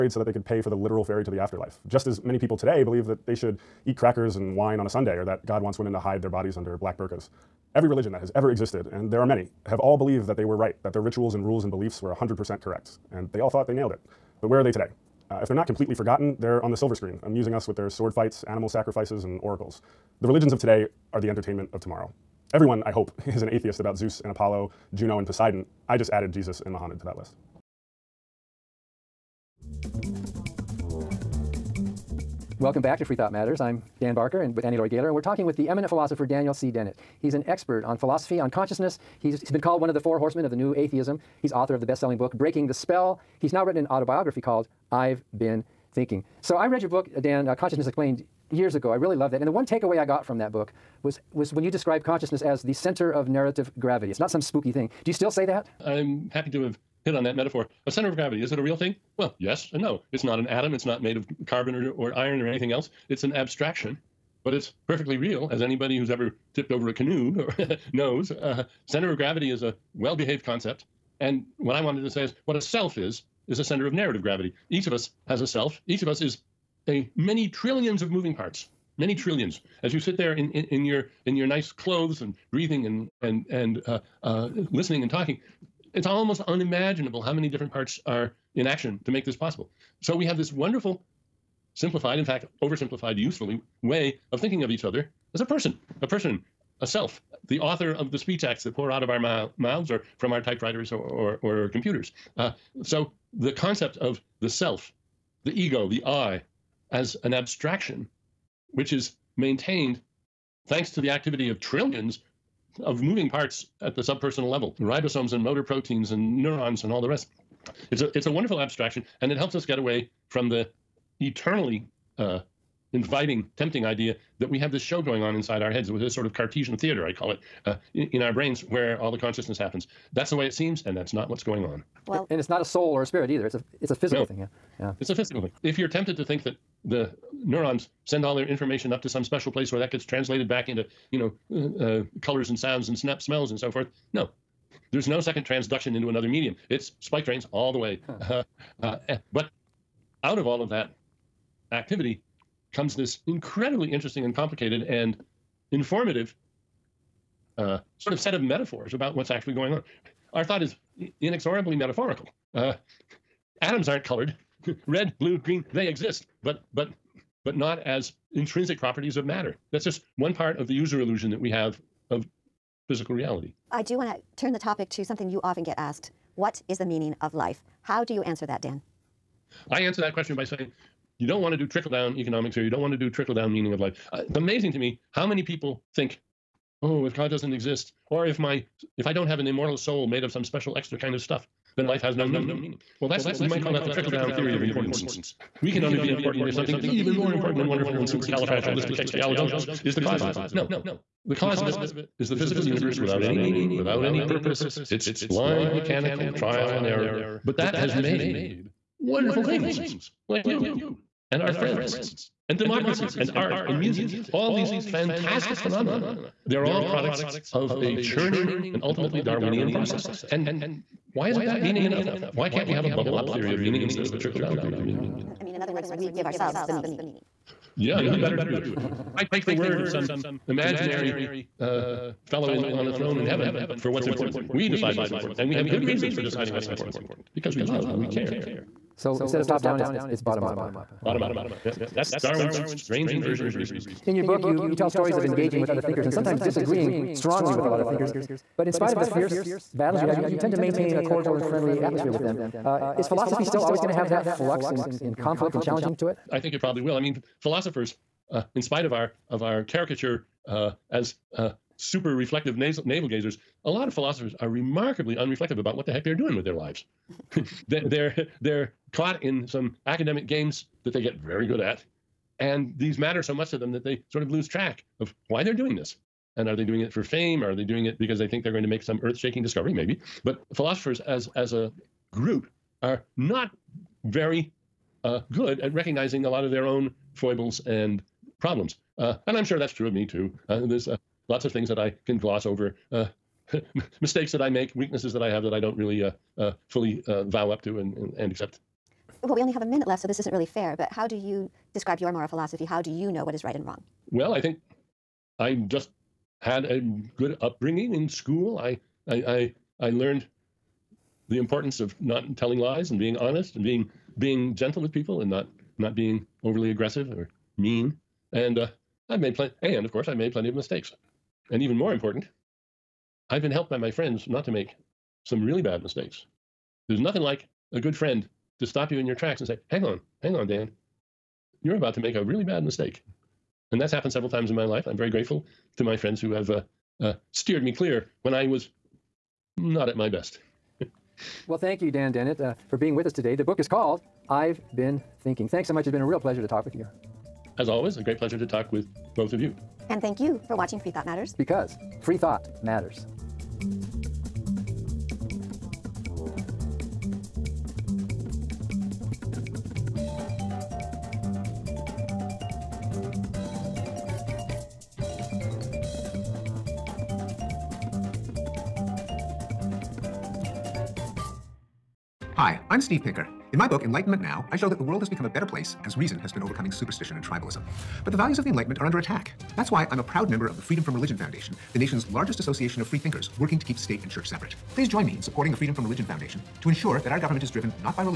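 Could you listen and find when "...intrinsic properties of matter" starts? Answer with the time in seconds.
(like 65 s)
168 s.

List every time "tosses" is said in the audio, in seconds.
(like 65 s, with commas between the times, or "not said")
not said.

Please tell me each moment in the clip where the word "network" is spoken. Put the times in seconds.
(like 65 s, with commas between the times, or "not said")
not said.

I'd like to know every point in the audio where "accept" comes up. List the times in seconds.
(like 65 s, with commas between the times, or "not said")
298 s.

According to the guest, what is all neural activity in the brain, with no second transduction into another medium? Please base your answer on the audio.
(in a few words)
spike trains.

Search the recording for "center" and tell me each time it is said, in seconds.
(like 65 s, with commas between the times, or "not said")
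52 s, 57 s, 68 s, 73 s.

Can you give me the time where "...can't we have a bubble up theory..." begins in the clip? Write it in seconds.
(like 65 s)
222 s.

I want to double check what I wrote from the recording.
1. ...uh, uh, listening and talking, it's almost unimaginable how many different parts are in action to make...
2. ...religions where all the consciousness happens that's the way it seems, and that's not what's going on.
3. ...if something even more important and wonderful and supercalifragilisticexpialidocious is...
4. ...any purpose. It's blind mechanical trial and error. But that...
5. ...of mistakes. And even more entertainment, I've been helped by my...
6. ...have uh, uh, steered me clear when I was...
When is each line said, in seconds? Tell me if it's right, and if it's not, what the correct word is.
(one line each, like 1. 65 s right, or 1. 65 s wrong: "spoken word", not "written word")
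1. 83 s right
2. 128 s wrong: "brains", not "religions"
3. 196 s right
4. 204 s right
5. 320 s wrong: "important", not "entertainment"
6. 336 s right.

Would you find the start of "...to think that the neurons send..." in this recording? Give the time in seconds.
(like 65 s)
136 s.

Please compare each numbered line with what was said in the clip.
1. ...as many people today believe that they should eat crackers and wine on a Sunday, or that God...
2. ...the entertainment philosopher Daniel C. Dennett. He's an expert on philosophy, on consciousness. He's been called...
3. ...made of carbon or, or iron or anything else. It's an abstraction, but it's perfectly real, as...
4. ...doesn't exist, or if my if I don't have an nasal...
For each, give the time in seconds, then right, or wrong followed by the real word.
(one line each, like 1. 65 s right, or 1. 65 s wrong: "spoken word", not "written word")
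1. 2 s right
2. 35 s wrong: "eminent", not "entertainment"
3. 61 s right
4. 187 s wrong: "immortal", not "nasal".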